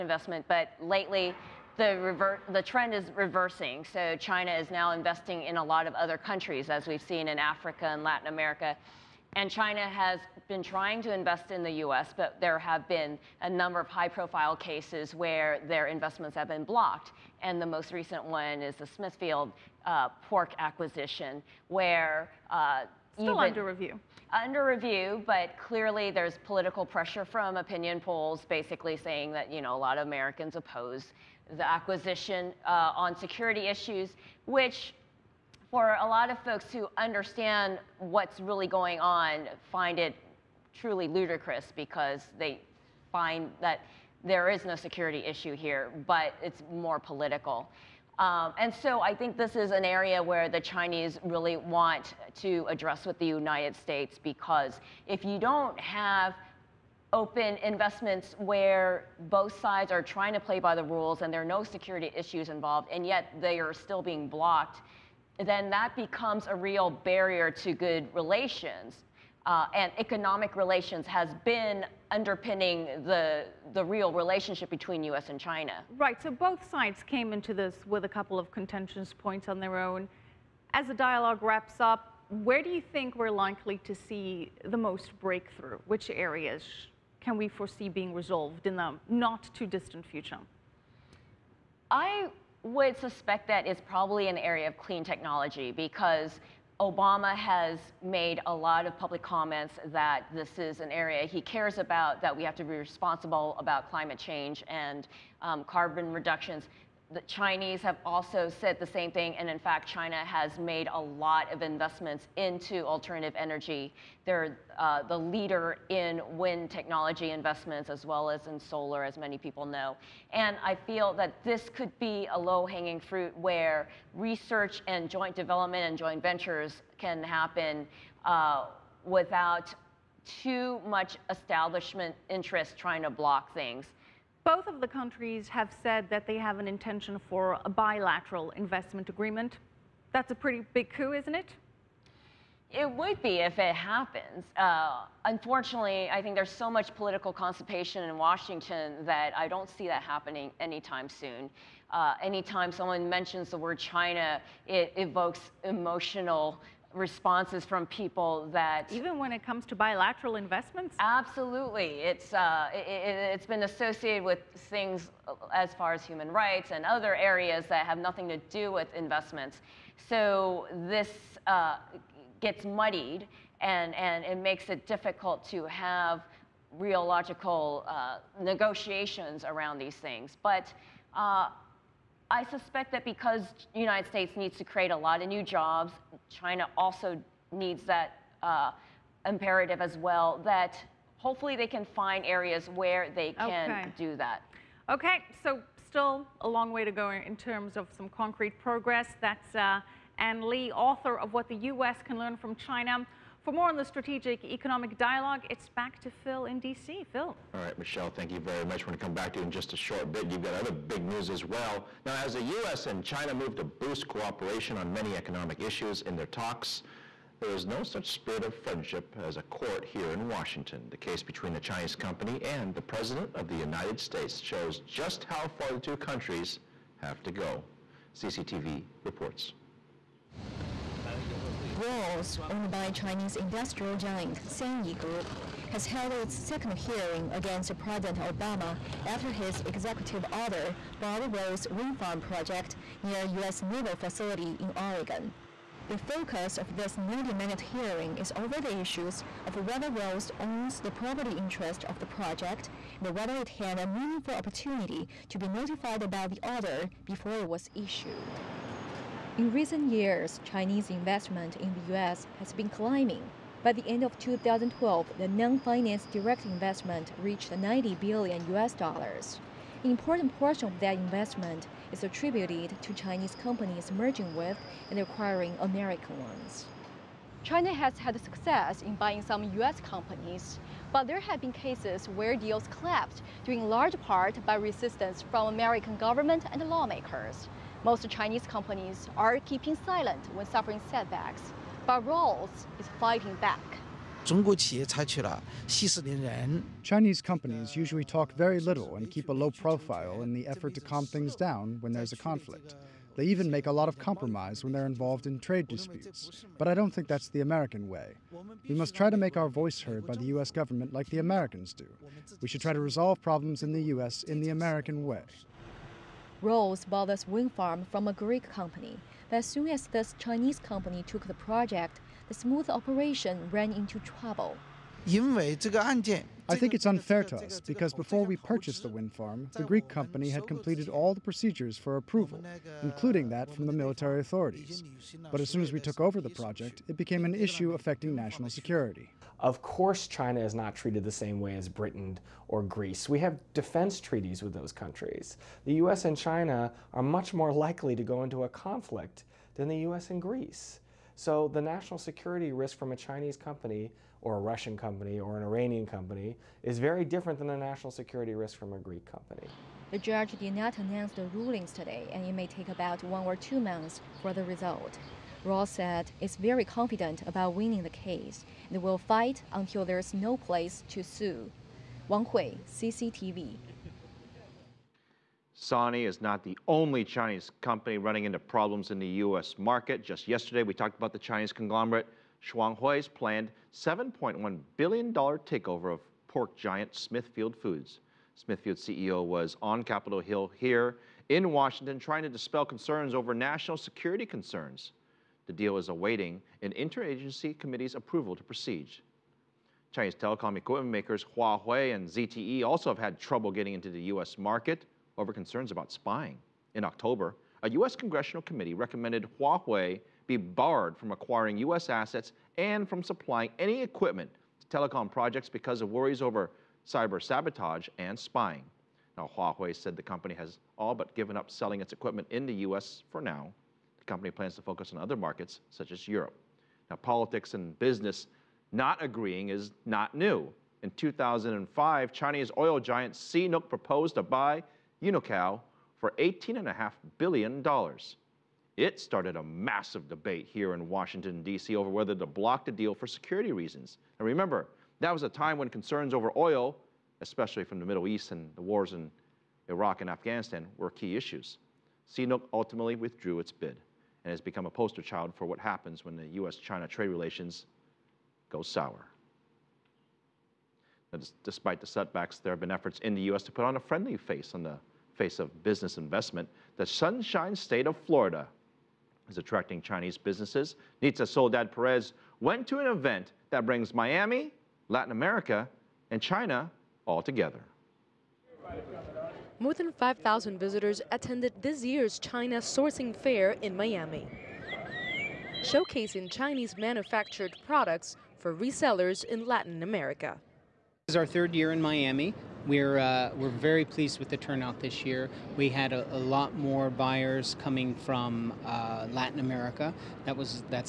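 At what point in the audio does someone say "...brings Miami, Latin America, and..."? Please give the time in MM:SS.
07:53.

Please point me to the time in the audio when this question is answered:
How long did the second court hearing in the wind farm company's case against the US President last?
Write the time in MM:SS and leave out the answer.
04:06.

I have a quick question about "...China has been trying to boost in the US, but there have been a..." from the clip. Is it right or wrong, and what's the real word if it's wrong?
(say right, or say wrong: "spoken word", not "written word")
wrong: "invest", not "boost".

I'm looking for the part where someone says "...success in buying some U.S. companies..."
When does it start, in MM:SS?
04:38.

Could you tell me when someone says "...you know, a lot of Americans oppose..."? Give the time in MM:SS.
00:29.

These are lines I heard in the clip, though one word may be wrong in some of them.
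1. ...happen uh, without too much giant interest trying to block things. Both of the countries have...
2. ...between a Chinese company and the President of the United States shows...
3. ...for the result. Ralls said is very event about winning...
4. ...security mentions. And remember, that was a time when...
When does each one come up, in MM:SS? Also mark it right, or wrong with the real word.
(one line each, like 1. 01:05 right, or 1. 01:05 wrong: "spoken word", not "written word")
1. 02:07 wrong: "establishment", not "giant"
2. 03:41 right
3. 06:04 wrong: "confident", not "event"
4. 07:23 wrong: "reasons", not "mentions".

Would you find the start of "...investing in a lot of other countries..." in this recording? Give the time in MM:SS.
00:04.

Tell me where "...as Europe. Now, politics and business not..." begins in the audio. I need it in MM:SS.
07:05.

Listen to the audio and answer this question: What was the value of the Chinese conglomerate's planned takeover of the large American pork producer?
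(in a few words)
$7.1 billion.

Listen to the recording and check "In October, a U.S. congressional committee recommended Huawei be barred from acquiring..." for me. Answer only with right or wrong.
right.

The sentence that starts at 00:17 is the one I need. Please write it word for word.
And the most recent one is the Smithfield uh, pork acquisition, where uh, Still even, under review.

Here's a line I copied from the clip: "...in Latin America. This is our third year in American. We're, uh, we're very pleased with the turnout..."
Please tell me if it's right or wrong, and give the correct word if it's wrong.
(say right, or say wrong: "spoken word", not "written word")
wrong: "Miami", not "American".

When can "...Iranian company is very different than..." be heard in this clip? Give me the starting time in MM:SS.
05:55.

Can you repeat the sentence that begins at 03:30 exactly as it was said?
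You've got other big news as well.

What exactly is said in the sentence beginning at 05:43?
We have defense treaties with those countries.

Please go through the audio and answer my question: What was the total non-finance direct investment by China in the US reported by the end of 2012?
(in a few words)
90 billion U.S. dollars.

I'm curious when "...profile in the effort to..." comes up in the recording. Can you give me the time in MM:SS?
04:59.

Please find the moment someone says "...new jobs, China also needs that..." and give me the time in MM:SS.
03:05.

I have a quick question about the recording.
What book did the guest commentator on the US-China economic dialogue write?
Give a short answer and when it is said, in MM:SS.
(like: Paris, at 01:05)
What the U.S. Can Learn from China, at 03:21.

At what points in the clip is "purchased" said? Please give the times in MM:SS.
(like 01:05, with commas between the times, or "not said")
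05:28.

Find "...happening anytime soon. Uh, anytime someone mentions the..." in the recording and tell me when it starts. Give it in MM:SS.
02:30.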